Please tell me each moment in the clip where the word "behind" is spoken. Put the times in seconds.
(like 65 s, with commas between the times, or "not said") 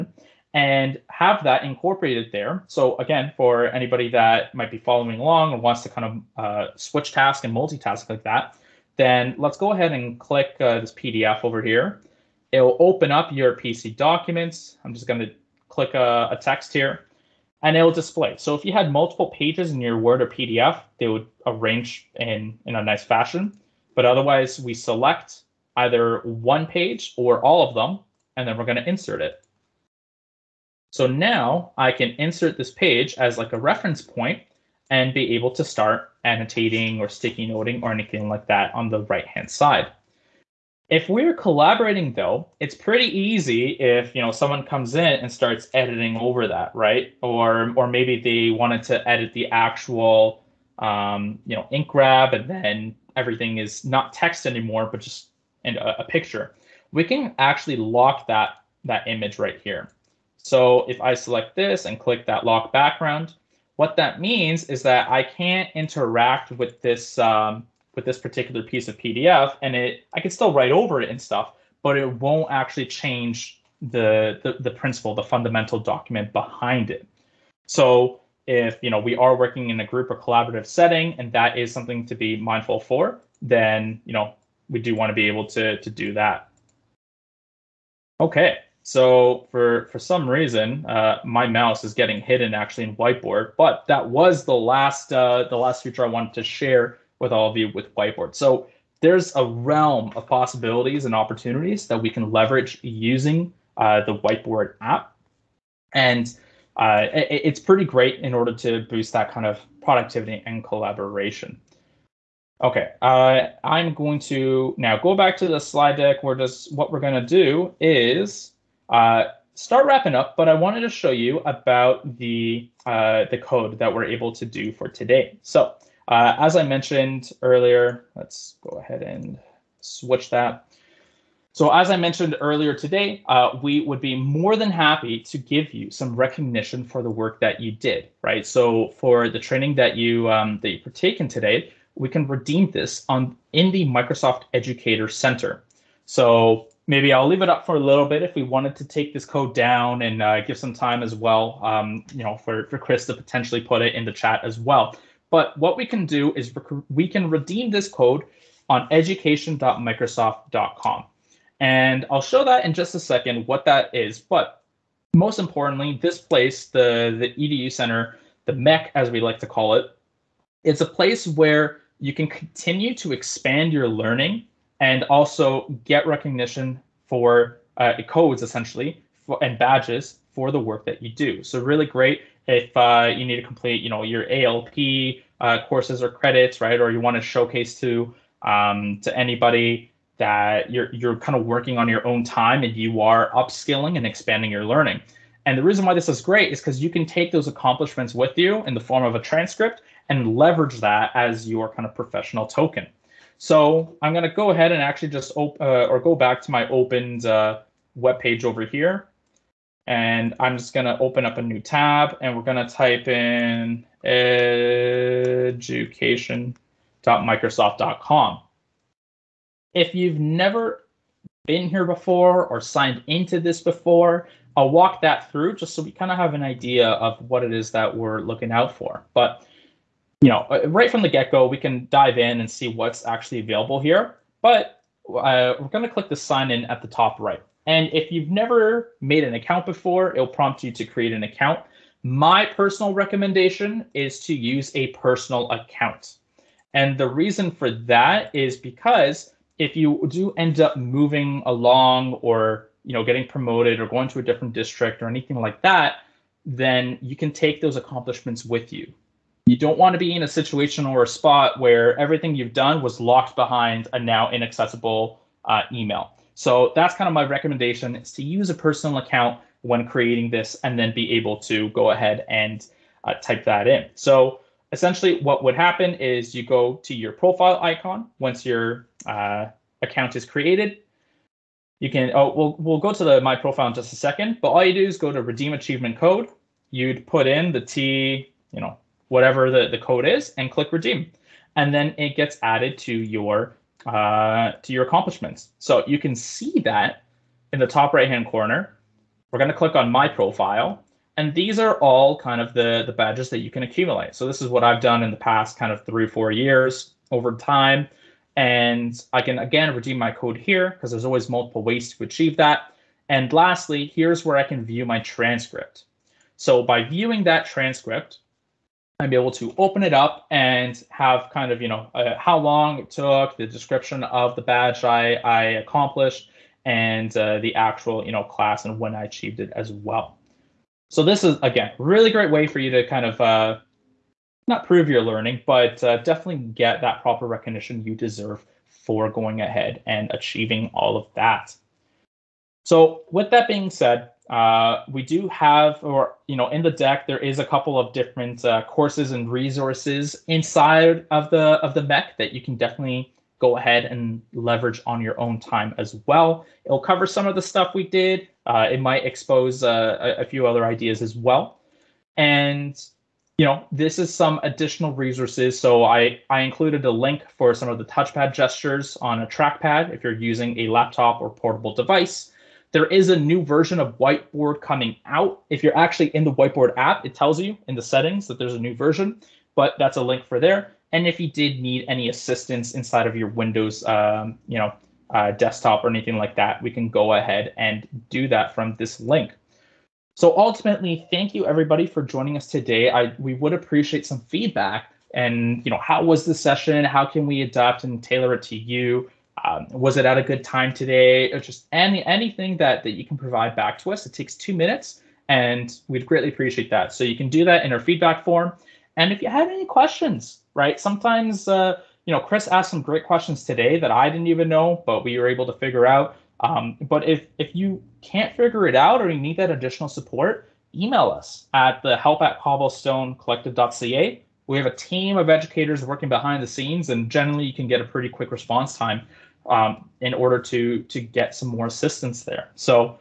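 76 s, 263 s, 426 s.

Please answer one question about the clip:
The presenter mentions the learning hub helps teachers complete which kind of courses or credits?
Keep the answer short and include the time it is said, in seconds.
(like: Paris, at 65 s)
ALP, at 184 s.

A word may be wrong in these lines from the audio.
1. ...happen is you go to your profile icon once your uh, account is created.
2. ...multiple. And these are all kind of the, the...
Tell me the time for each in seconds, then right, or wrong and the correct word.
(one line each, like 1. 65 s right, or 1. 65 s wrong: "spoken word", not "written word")
1. 275 s right
2. 300 s wrong: "profile", not "multiple".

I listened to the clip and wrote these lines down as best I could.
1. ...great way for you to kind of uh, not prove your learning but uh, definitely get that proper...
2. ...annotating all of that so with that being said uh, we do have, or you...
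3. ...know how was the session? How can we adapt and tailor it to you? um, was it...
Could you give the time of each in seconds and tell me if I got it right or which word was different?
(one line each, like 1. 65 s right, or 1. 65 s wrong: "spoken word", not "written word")
1. 332 s right
2. 340 s wrong: "achieving", not "annotating"
3. 395 s right.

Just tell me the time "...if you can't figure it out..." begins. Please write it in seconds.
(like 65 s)
417 s.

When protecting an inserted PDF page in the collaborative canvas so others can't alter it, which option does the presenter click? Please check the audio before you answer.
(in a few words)
Lock background.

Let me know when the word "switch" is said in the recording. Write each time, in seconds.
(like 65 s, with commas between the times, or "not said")
6 s, 129 s.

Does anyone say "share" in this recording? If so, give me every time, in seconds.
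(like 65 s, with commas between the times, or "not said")
96 s.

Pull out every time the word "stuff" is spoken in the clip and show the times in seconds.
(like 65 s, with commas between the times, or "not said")
71 s, 357 s.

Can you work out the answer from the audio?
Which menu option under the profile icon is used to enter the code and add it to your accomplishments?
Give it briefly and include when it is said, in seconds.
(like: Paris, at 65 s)
Redeem Achievement Code, at 285 s.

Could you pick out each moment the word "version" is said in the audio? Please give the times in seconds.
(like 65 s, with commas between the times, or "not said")
373 s, 378 s.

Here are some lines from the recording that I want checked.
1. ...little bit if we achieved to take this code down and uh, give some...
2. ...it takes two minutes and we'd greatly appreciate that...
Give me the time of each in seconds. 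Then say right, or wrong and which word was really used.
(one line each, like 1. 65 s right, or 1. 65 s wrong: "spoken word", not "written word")
1. 147 s wrong: "wanted", not "achieved"
2. 404 s right.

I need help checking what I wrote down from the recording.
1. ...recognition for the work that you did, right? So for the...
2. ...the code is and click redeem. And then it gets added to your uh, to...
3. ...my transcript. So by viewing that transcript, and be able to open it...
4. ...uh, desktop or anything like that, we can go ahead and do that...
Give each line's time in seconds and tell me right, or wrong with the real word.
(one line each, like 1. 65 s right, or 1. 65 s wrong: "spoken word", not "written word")
1. 136 s right
2. 289 s right
3. 314 s right
4. 385 s right.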